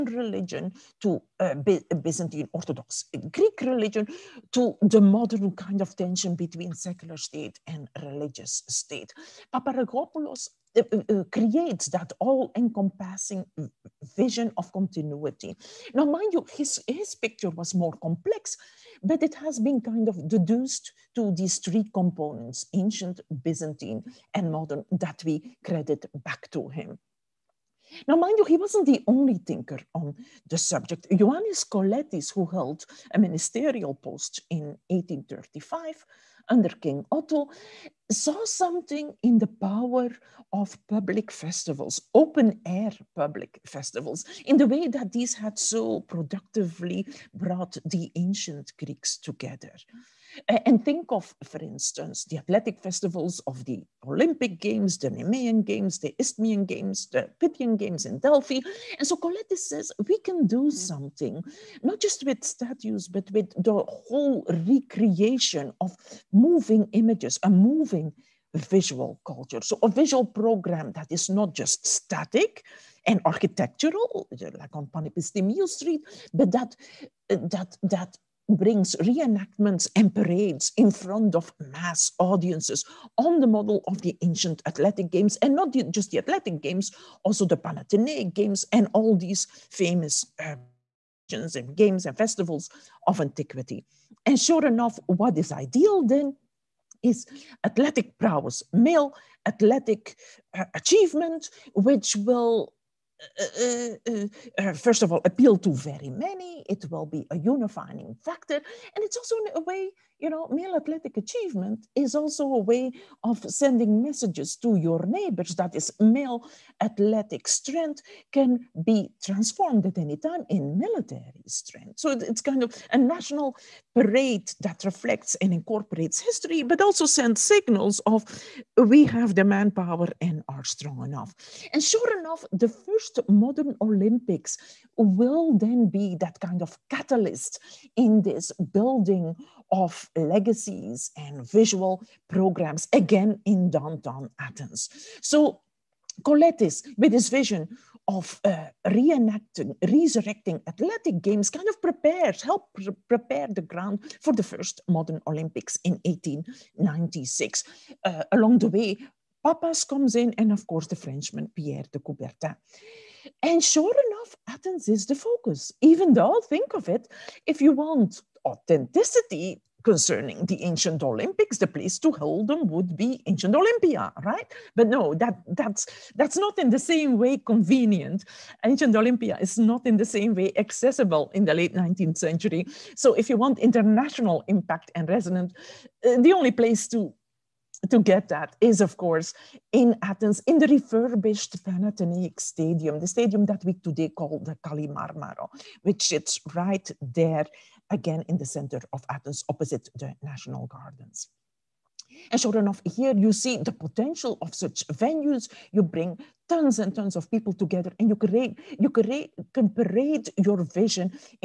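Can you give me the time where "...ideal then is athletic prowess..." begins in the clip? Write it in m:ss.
1:35.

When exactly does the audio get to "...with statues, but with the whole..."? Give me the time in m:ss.
1:02.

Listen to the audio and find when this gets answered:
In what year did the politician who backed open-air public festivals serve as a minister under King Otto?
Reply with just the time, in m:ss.
0:34.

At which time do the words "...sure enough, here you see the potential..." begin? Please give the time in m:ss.
3:22.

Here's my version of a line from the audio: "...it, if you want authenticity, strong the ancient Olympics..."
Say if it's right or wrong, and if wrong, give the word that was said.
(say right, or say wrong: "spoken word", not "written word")
wrong: "concerning", not "strong".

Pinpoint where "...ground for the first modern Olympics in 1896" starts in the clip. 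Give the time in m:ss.
2:33.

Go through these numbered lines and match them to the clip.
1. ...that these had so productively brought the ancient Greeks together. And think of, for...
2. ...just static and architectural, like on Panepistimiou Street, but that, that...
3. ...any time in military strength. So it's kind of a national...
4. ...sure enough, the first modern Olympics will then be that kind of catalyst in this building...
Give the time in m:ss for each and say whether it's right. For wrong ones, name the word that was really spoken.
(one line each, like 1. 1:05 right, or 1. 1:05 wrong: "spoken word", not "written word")
1. 0:44 right
2. 1:11 right
3. 1:59 right
4. 2:11 right.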